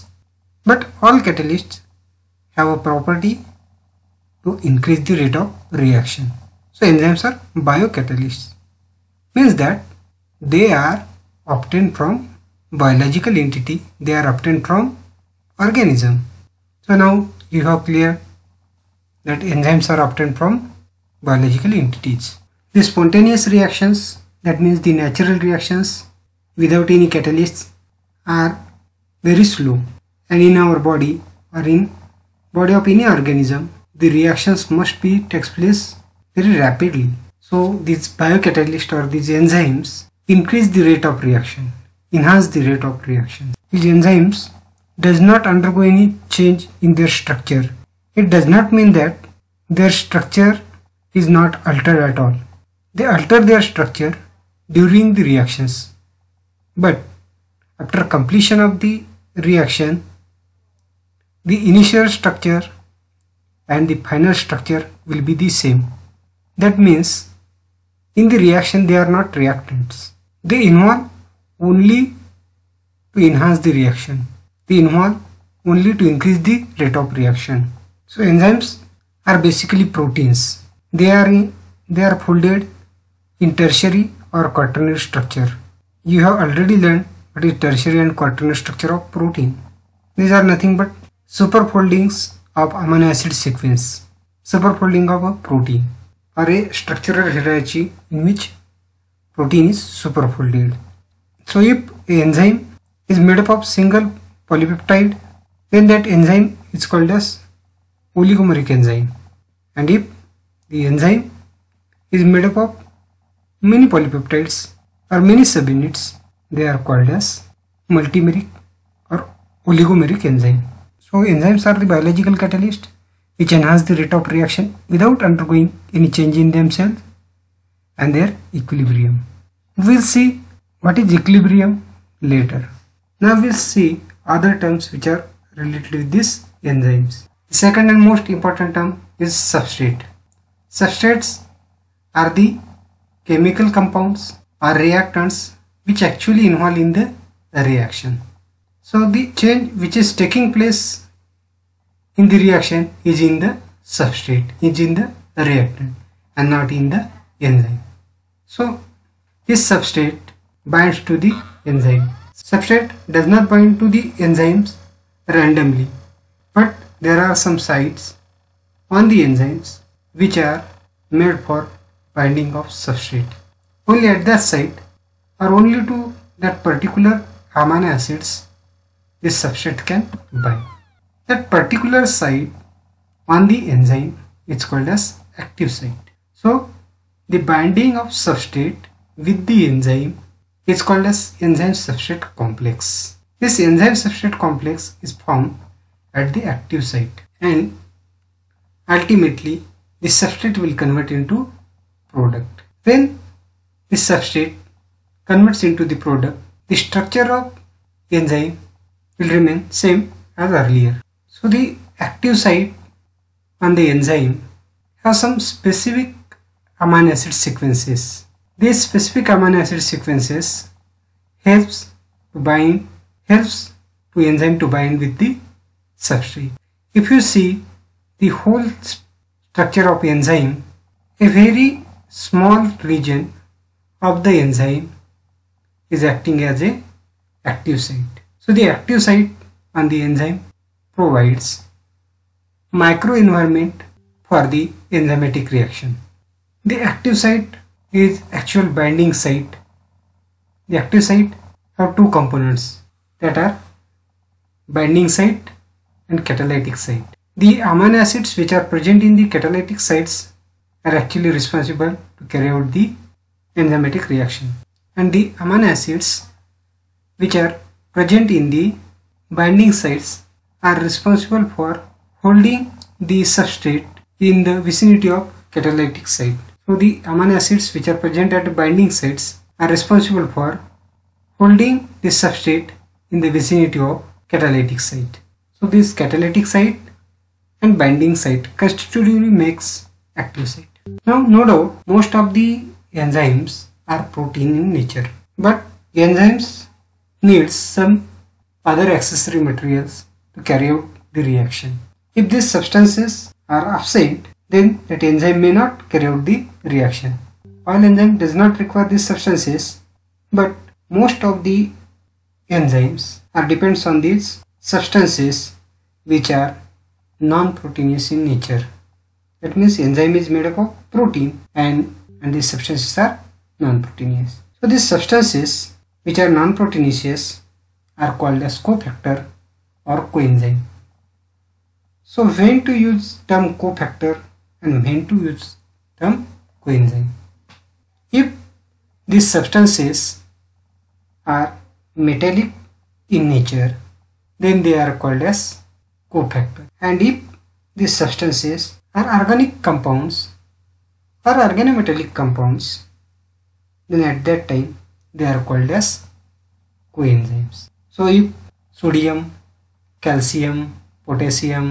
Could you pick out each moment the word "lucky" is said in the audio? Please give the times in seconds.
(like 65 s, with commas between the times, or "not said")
not said.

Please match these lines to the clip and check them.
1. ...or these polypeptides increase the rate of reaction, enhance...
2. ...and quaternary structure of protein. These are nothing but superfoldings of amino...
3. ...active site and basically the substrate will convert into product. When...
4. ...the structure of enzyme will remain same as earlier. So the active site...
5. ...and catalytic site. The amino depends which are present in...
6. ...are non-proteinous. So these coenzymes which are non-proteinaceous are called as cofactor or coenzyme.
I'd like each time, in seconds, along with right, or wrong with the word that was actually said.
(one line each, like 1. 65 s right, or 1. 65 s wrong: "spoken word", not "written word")
1. 38 s wrong: "enzymes", not "polypeptides"
2. 88 s right
3. 196 s wrong: "ultimately", not "basically"
4. 206 s right
5. 256 s wrong: "acids", not "depends"
6. 322 s wrong: "substances", not "coenzymes".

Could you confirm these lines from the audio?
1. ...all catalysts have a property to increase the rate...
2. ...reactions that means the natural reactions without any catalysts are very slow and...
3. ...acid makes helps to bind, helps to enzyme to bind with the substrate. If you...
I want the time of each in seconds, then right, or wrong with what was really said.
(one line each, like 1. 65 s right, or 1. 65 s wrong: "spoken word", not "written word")
1. 1 s right
2. 23 s right
3. 219 s wrong: "sequences", not "makes".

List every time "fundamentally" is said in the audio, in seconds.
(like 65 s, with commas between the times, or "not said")
not said.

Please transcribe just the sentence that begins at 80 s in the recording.
They are, in, they are folded in tertiary or quaternary structure.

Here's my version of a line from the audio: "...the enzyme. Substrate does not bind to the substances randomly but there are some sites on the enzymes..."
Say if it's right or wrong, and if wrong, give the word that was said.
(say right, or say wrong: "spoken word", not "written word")
wrong: "enzymes", not "substances".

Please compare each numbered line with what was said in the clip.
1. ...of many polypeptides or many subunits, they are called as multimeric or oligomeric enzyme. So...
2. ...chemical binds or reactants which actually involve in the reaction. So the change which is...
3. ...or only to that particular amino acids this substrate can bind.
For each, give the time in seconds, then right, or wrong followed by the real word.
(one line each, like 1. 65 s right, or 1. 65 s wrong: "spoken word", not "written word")
1. 112 s right
2. 143 s wrong: "compounds", not "binds"
3. 175 s right.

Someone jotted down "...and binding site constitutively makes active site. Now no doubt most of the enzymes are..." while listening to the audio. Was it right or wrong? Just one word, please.
right.